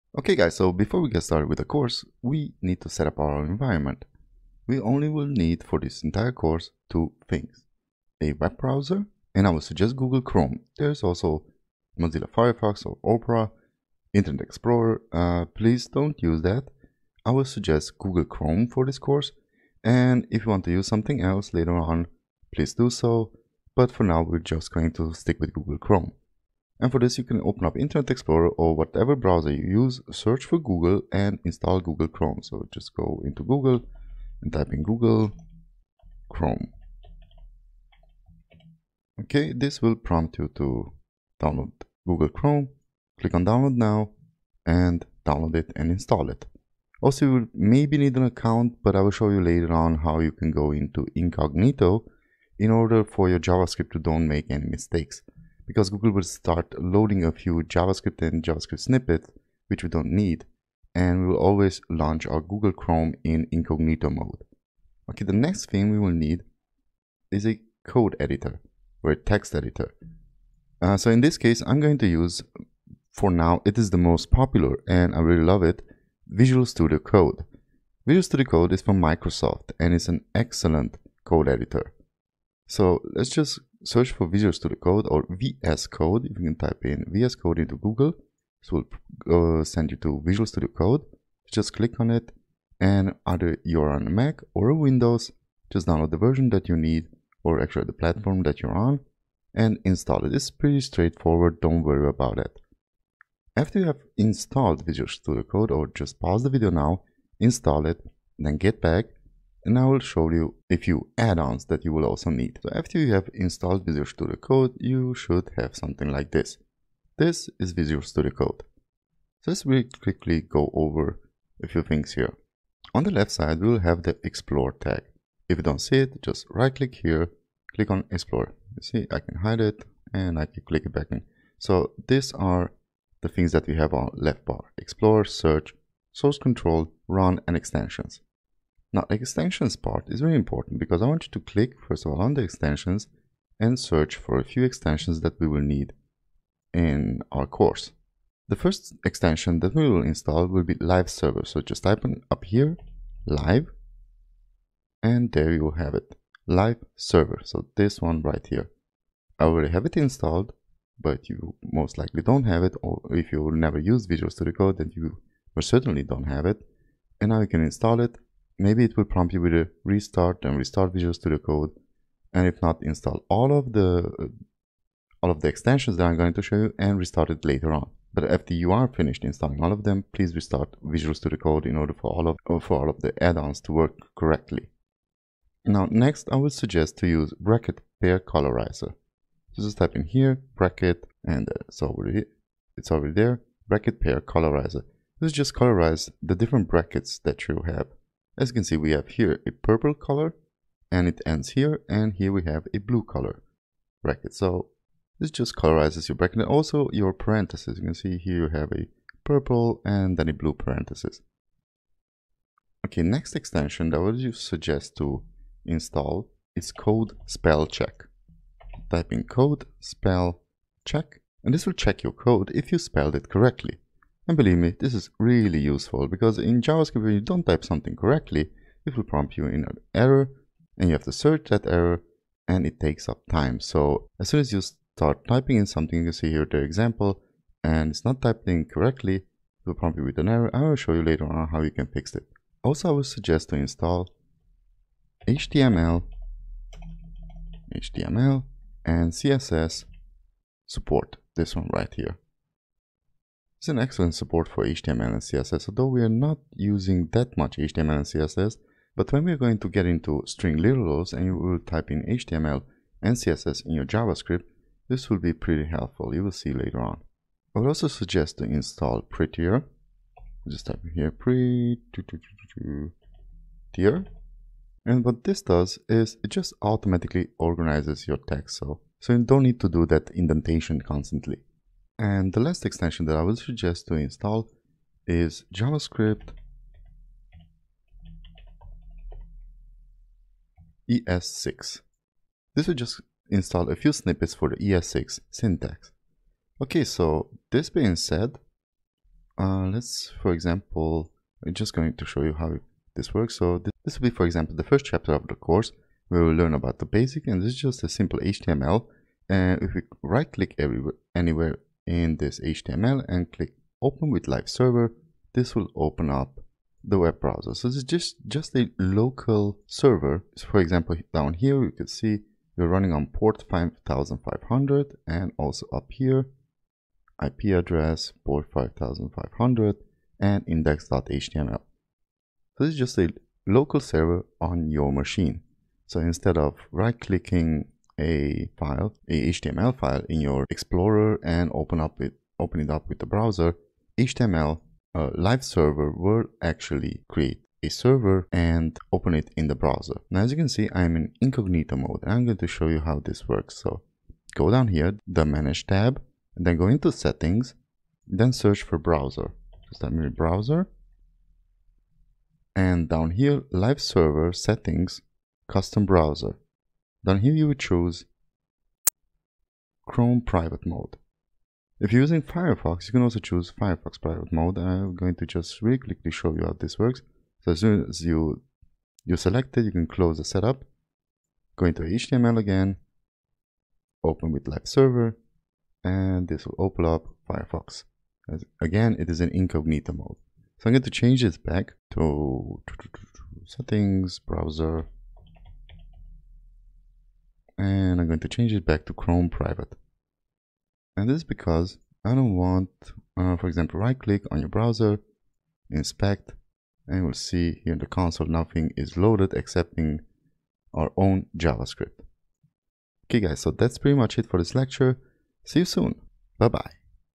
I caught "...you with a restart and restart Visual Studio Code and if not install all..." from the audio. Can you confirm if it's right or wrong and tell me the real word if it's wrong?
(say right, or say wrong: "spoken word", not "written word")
right.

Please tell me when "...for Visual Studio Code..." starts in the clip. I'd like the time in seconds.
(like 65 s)
84 s.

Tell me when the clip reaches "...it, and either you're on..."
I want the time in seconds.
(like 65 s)
92 s.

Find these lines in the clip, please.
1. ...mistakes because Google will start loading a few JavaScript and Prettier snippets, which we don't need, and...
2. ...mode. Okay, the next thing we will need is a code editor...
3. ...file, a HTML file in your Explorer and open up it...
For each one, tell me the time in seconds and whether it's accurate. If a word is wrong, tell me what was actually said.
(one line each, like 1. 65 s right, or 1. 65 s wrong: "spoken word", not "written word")
1. 54 s wrong: "JavaScript", not "Prettier"
2. 64 s right
3. 338 s right.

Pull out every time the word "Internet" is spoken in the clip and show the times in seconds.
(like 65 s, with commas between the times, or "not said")
14 s, 27 s.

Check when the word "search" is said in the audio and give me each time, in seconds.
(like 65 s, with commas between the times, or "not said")
30 s, 83 s, 135 s, 143 s, 231 s, 358 s.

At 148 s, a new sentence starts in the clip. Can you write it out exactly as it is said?
The first extension that we will install will be live server.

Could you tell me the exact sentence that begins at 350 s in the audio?
Now, as you can see, I'm in incognito mode and I'm going to show you how this works.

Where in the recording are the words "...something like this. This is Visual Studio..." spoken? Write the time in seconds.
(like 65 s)
115 s.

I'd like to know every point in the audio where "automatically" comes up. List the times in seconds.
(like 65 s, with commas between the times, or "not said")
276 s.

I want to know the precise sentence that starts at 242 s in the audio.
Also, I would suggest to install HTML, HTML and CSS support, this one right here.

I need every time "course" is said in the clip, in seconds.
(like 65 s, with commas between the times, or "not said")
1 s, 6 s, 18 s, 147 s, 305 s.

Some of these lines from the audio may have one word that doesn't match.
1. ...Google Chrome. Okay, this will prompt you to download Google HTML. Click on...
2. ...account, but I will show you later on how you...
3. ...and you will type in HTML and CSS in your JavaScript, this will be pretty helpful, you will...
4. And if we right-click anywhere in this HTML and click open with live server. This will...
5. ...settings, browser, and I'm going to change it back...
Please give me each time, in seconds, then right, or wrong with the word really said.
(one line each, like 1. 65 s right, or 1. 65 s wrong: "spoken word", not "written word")
1. 34 s wrong: "Chrome", not "HTML"
2. 48 s right
3. 261 s right
4. 309 s right
5. 393 s right.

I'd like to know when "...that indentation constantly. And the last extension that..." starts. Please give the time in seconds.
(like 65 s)
279 s.